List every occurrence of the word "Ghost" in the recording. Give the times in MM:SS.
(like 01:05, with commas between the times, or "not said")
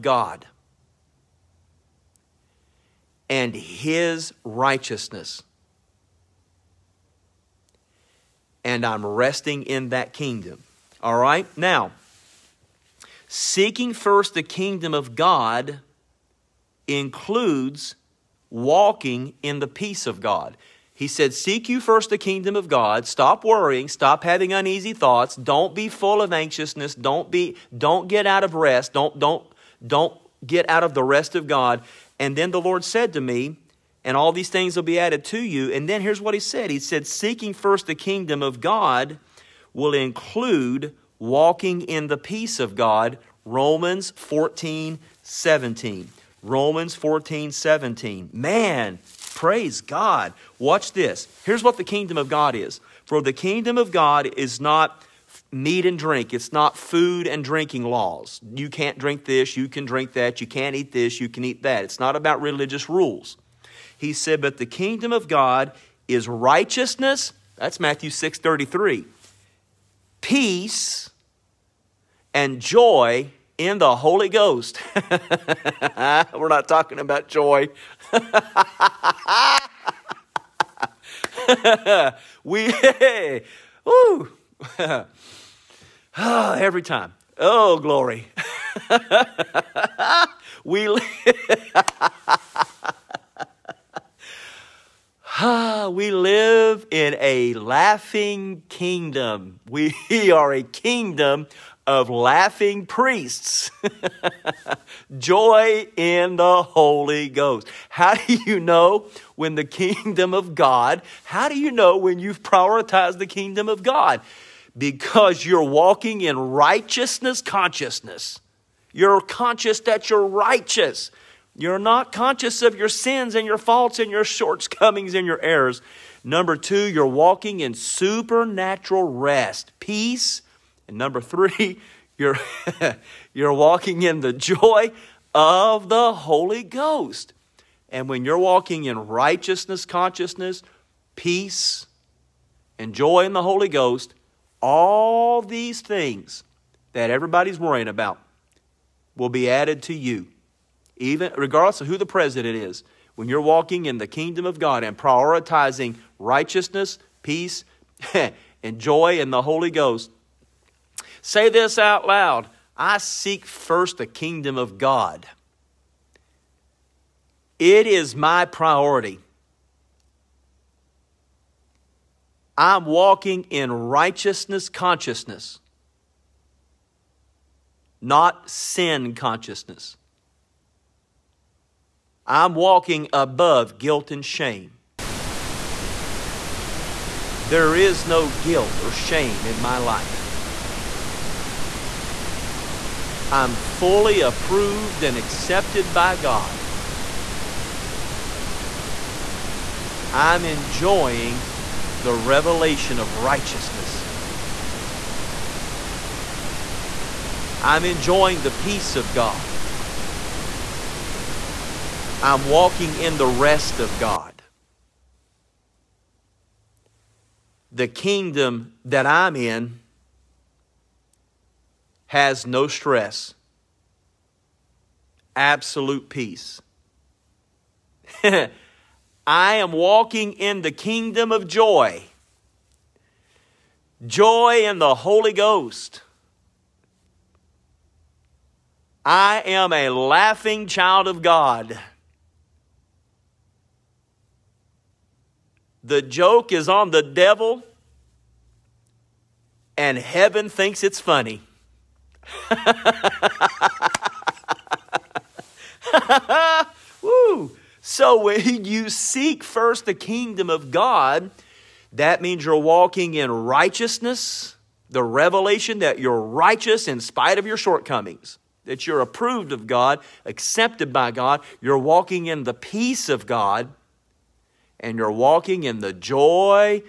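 01:14, 01:47, 02:16, 02:23, 02:39, 03:55.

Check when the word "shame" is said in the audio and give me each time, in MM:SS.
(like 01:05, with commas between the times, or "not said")
03:04, 03:08.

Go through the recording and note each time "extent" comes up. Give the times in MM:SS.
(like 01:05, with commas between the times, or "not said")
not said.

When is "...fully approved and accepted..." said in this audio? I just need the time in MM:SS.
03:13.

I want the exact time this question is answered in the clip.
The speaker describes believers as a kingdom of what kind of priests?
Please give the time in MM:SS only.
01:42.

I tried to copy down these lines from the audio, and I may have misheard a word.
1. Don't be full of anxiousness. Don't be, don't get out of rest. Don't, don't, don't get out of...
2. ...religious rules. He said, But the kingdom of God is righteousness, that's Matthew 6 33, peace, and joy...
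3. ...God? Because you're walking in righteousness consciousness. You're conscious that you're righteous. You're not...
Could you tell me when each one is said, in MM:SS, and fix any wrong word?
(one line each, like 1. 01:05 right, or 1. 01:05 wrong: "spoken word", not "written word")
1. 00:25 right
2. 01:02 right
3. 01:53 right.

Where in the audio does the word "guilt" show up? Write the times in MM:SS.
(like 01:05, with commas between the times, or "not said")
03:03, 03:08.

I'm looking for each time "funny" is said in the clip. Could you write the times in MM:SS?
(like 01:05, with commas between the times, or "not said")
04:10.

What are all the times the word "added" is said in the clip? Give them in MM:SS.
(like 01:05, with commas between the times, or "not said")
00:34, 02:29.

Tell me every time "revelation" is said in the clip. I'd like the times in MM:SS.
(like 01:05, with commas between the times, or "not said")
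03:22, 04:25.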